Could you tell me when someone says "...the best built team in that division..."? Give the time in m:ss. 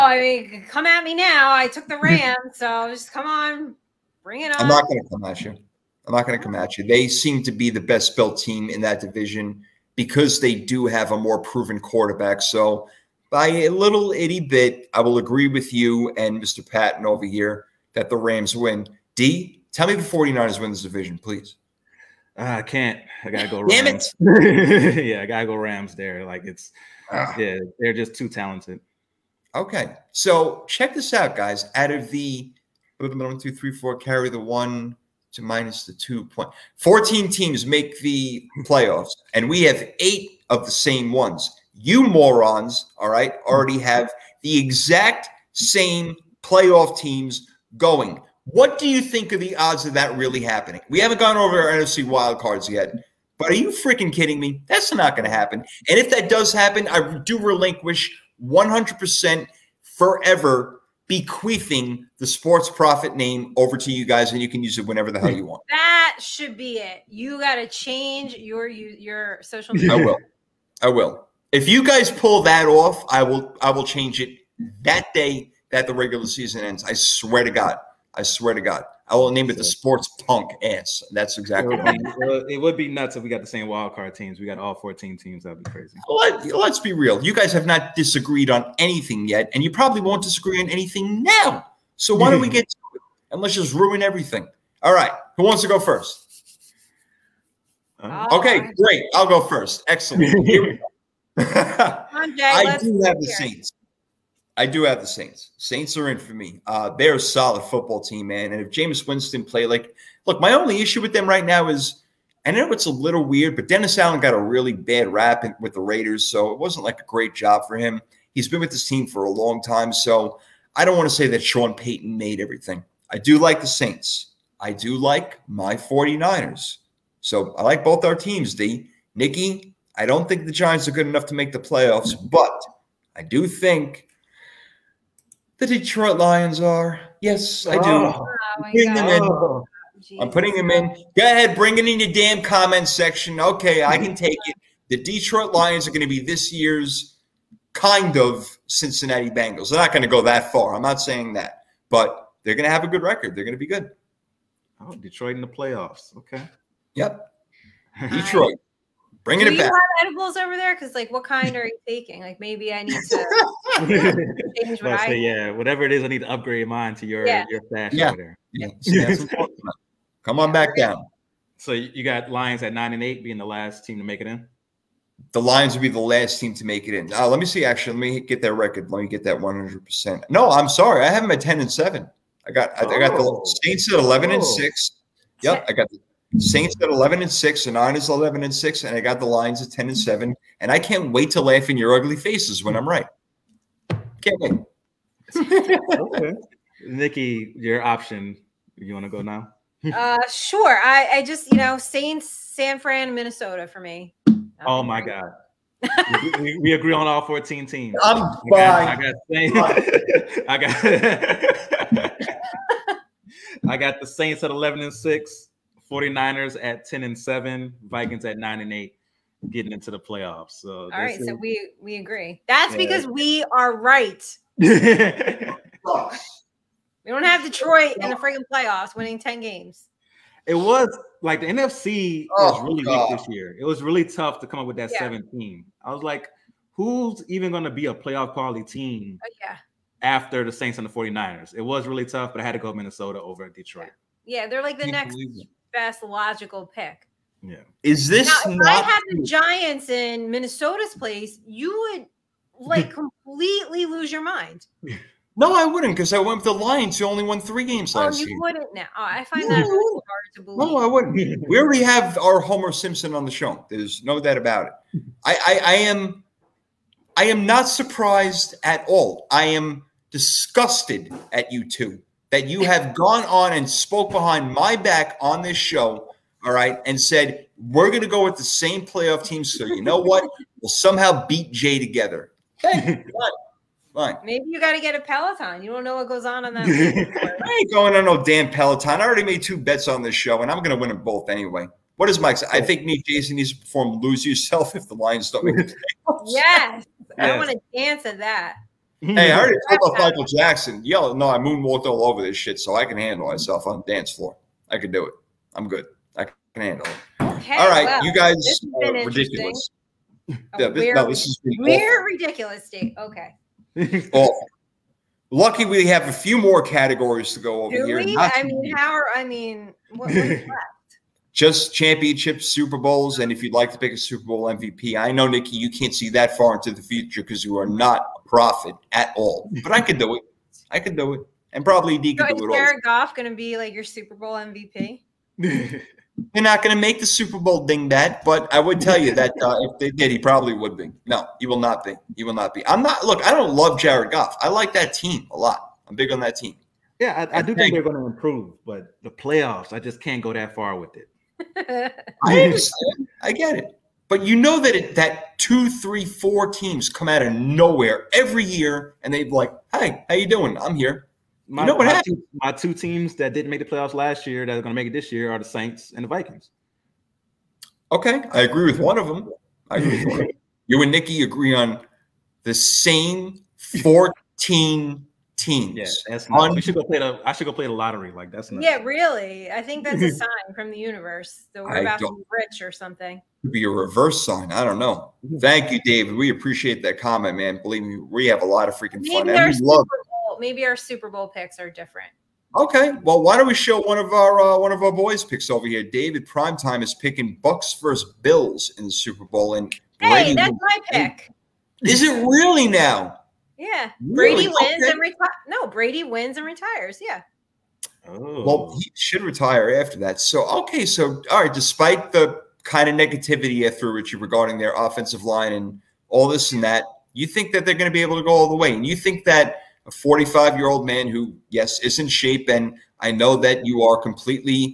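0:07.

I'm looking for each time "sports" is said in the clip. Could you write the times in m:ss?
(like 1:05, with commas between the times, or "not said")
1:02, 1:19.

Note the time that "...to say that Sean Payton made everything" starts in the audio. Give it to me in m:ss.
2:01.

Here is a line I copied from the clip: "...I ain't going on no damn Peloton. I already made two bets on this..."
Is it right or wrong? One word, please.
right.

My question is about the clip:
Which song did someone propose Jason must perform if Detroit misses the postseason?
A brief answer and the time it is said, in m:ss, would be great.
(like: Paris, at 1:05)
Lose Yourself, at 4:54.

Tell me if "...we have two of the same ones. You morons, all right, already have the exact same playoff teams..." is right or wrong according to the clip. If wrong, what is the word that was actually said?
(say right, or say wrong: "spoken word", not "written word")
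wrong: "eight", not "two".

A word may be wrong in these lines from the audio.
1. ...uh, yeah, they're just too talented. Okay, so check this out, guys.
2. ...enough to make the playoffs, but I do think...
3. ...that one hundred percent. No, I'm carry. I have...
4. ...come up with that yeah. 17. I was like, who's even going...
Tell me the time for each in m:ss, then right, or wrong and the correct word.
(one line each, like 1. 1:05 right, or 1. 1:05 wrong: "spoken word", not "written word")
1. 0:27 right
2. 2:11 right
3. 2:59 wrong: "sorry", not "carry"
4. 3:54 right.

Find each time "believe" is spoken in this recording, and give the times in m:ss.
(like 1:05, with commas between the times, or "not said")
4:20, 6:27.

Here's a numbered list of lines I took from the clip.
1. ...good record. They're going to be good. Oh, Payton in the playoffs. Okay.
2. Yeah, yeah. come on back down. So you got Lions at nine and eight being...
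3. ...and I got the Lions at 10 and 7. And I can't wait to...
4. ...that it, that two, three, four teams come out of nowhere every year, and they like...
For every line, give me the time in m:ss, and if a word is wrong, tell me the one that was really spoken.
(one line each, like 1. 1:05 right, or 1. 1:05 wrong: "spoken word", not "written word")
1. 2:32 wrong: "Detroit", not "Payton"
2. 2:48 right
3. 3:08 right
4. 5:54 right.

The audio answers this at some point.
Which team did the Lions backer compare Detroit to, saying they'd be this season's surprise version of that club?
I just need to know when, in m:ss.
2:28.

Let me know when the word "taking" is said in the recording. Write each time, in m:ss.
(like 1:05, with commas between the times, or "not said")
2:41.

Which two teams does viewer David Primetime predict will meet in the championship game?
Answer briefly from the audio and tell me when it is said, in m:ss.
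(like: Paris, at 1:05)
Bucks versus Bills, at 6:37.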